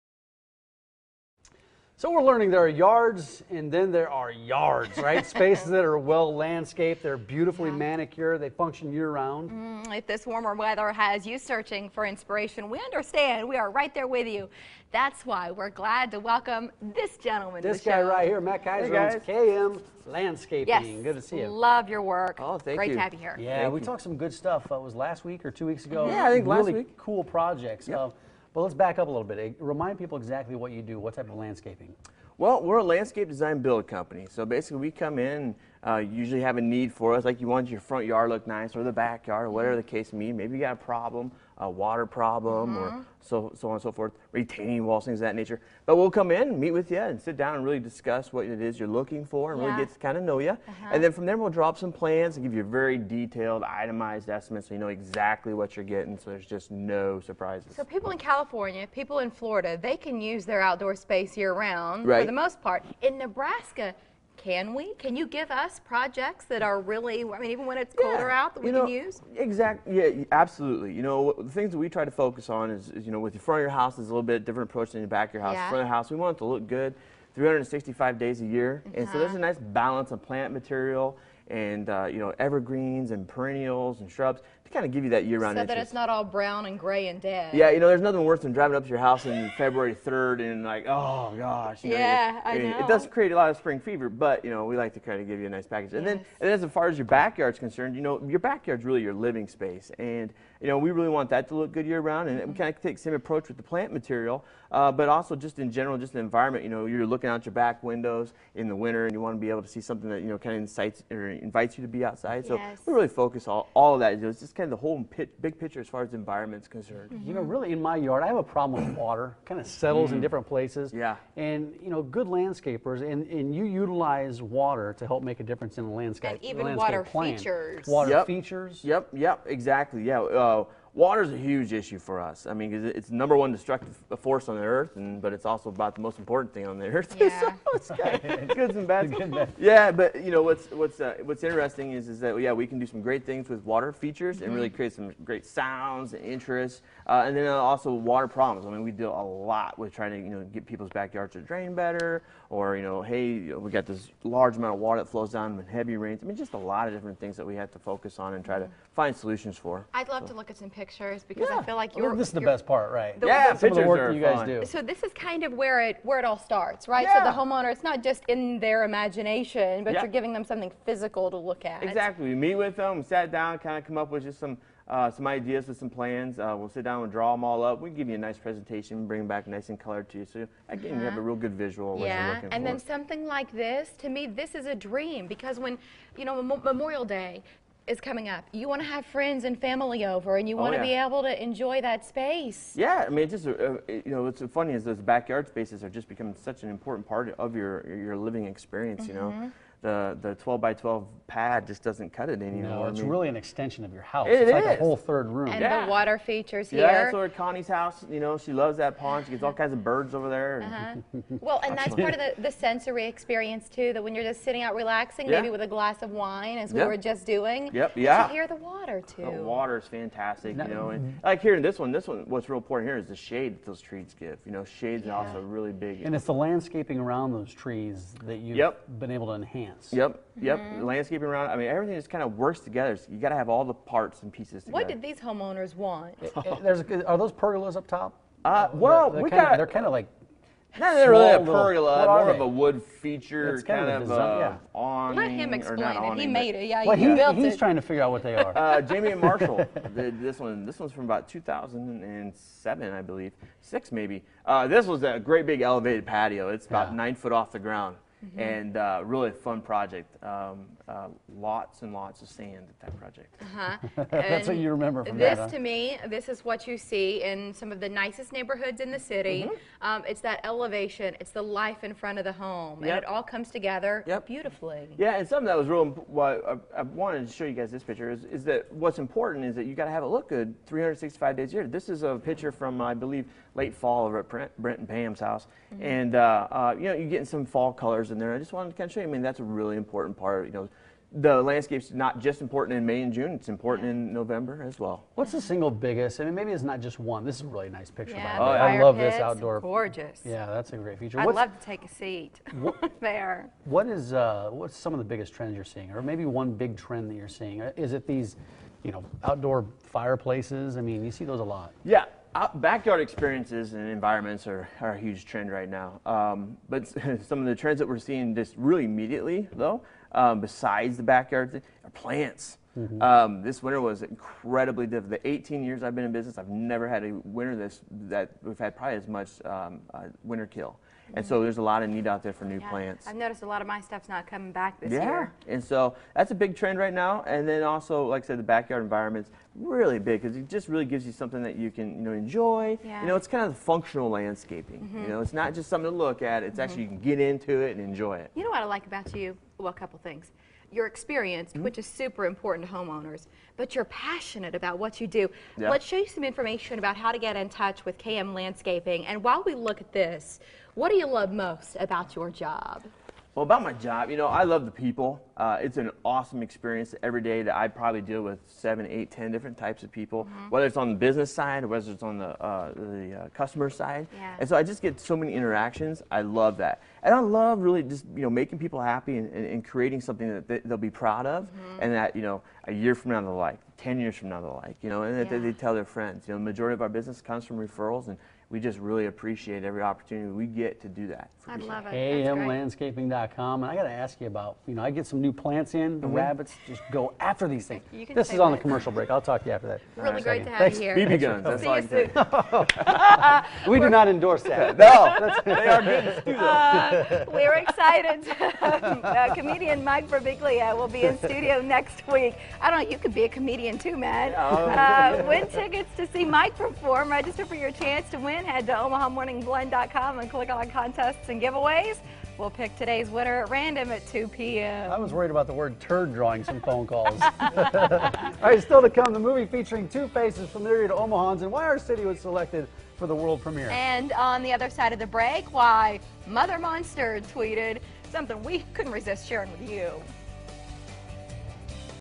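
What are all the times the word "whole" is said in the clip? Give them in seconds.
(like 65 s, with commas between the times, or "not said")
114 s, 204 s.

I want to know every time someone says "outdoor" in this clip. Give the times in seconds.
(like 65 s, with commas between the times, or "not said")
60 s, 299 s, 309 s.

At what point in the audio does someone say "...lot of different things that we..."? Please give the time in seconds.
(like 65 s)
156 s.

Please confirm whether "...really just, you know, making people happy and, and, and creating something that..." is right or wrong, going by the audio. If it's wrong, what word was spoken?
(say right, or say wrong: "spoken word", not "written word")
right.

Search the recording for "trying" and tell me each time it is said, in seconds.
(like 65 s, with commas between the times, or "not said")
149 s, 247 s.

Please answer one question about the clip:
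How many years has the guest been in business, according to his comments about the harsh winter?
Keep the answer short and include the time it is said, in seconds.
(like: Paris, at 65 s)
18, at 325 s.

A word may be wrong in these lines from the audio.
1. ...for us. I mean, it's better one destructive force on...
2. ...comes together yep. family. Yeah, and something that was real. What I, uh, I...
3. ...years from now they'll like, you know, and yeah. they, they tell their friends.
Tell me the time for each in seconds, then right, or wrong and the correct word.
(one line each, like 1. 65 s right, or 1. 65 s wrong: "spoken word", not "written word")
1. 131 s wrong: "number", not "better"
2. 273 s wrong: "beautifully", not "family"
3. 383 s right.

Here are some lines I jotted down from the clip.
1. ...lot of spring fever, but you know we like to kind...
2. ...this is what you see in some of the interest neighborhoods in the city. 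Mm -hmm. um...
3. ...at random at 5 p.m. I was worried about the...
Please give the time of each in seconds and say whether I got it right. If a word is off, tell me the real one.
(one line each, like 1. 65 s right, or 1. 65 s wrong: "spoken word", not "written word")
1. 93 s right
2. 266 s wrong: "nicest", not "interest"
3. 423 s wrong: "2", not "5".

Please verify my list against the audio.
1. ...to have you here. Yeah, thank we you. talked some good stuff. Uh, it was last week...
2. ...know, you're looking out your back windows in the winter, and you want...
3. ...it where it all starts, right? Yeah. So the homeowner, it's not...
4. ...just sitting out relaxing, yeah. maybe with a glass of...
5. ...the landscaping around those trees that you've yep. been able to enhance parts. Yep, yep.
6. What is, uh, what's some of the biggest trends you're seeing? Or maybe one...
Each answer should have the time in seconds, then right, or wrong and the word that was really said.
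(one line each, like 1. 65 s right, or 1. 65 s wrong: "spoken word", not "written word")
1. 22 s right
2. 106 s right
3. 165 s right
4. 214 s right
5. 226 s wrong: "plants", not "parts"
6. 303 s right.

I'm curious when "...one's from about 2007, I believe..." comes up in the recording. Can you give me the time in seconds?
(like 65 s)
250 s.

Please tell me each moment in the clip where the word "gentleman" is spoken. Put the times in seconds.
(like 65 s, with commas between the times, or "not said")
17 s.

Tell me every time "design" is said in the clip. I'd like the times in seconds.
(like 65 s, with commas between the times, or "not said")
33 s, 244 s.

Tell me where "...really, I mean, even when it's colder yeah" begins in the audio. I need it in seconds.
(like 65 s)
66 s.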